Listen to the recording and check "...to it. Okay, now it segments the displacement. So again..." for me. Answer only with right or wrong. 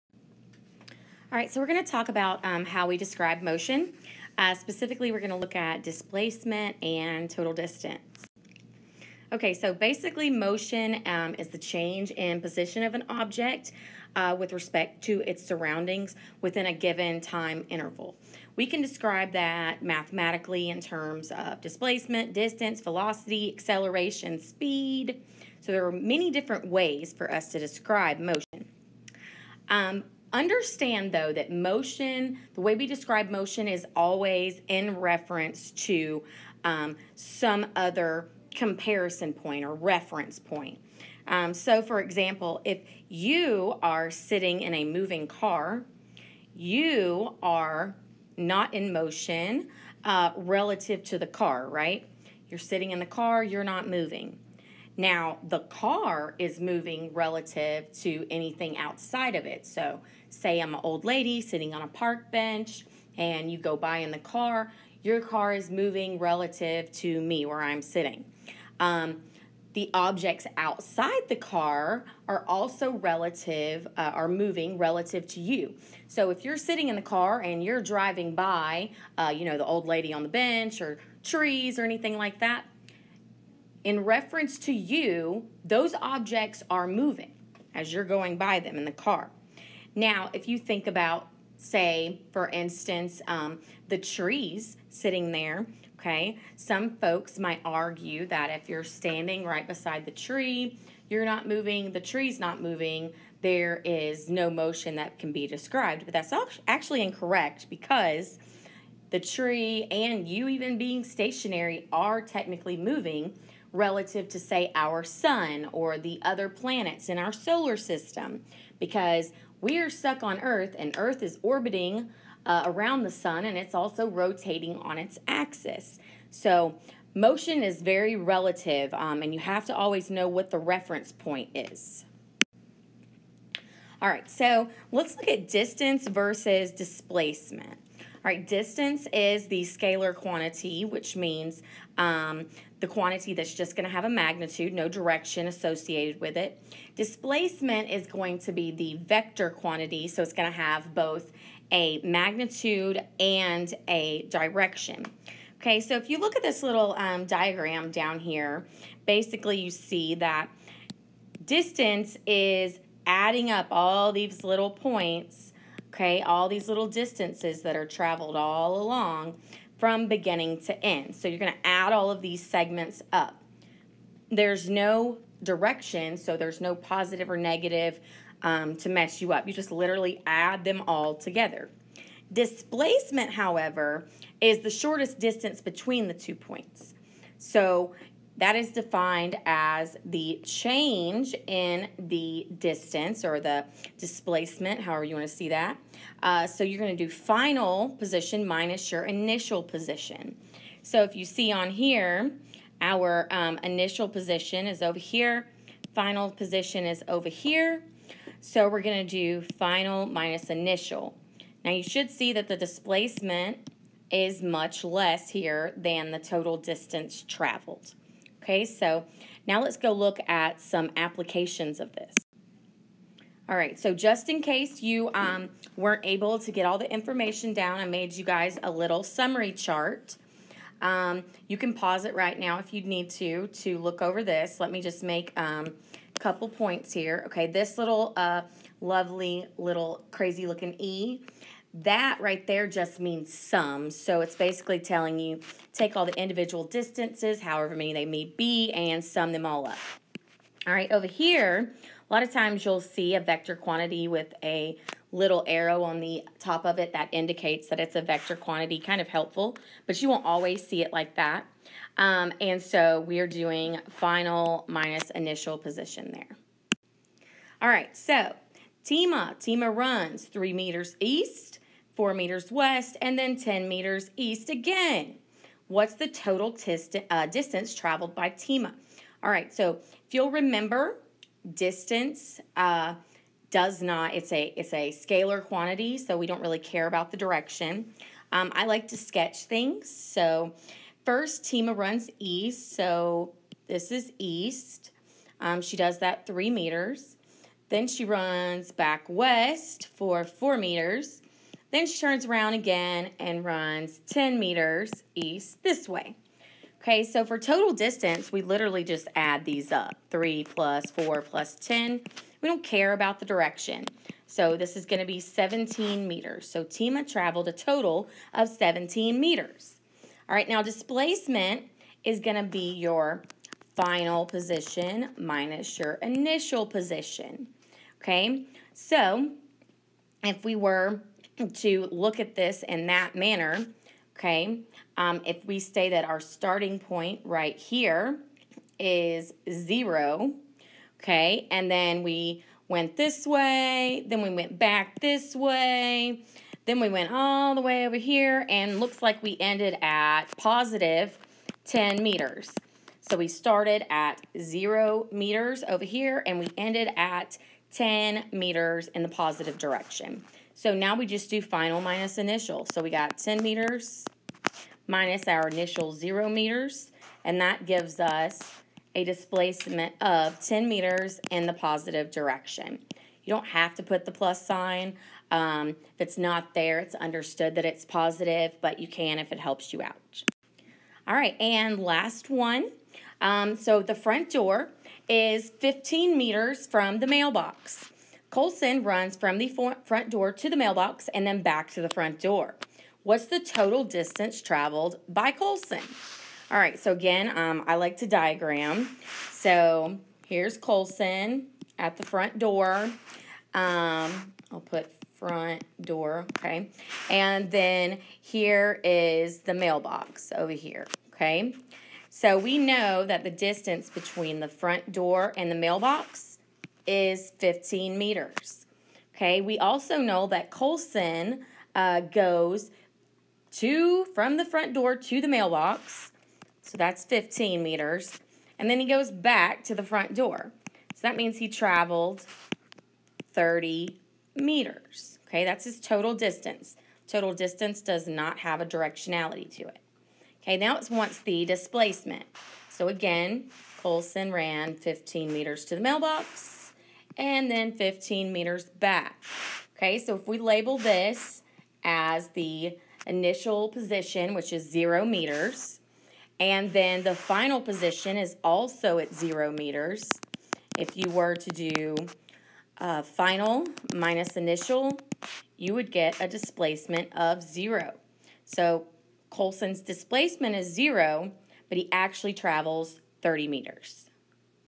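wrong.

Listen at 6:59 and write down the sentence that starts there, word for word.
Okay, we also know that Colson uh, goes to from the front door to the mailbox.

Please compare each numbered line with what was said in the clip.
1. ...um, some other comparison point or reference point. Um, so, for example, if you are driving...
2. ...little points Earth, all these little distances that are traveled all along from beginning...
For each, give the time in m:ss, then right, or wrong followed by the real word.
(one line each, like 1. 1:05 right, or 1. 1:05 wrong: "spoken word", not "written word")
1. 0:36 wrong: "sitting", not "driving"
2. 2:44 wrong: "Okay", not "Earth".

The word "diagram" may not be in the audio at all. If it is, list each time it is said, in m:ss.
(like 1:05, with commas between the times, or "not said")
2:37, 6:38.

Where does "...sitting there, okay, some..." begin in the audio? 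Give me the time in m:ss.
1:34.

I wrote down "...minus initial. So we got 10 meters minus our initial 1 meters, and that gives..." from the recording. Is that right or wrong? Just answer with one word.
wrong.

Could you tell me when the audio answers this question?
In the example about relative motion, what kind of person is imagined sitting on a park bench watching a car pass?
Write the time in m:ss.
1:00.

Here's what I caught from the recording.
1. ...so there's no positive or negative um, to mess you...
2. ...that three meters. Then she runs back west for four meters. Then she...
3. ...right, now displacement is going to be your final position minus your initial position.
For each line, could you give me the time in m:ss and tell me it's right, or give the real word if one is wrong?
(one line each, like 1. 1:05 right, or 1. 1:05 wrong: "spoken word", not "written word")
1. 2:56 right
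2. 4:55 right
3. 5:20 right.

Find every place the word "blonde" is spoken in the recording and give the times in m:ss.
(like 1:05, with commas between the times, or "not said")
not said.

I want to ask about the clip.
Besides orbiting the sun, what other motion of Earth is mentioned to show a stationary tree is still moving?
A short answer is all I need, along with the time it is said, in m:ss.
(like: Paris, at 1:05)
rotating on its axis, at 2:04.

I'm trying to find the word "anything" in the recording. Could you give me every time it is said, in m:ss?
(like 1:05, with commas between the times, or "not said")
0:58, 1:21.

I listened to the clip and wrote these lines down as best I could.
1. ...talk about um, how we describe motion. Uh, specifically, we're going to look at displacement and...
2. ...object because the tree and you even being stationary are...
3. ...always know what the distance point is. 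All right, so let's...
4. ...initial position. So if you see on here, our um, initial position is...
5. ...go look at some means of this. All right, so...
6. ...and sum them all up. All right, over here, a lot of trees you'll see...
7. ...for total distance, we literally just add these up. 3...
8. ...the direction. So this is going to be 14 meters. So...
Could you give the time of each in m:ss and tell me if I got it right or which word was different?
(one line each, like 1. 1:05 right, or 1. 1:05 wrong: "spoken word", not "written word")
1. 0:01 right
2. 1:47 wrong: "incorrect", not "object"
3. 2:09 wrong: "reference", not "distance"
4. 3:19 right
5. 3:39 wrong: "applications", not "means"
6. 4:08 wrong: "times", not "trees"
7. 5:07 right
8. 5:13 wrong: "17", not "14".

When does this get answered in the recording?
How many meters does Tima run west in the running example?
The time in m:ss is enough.
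4:31.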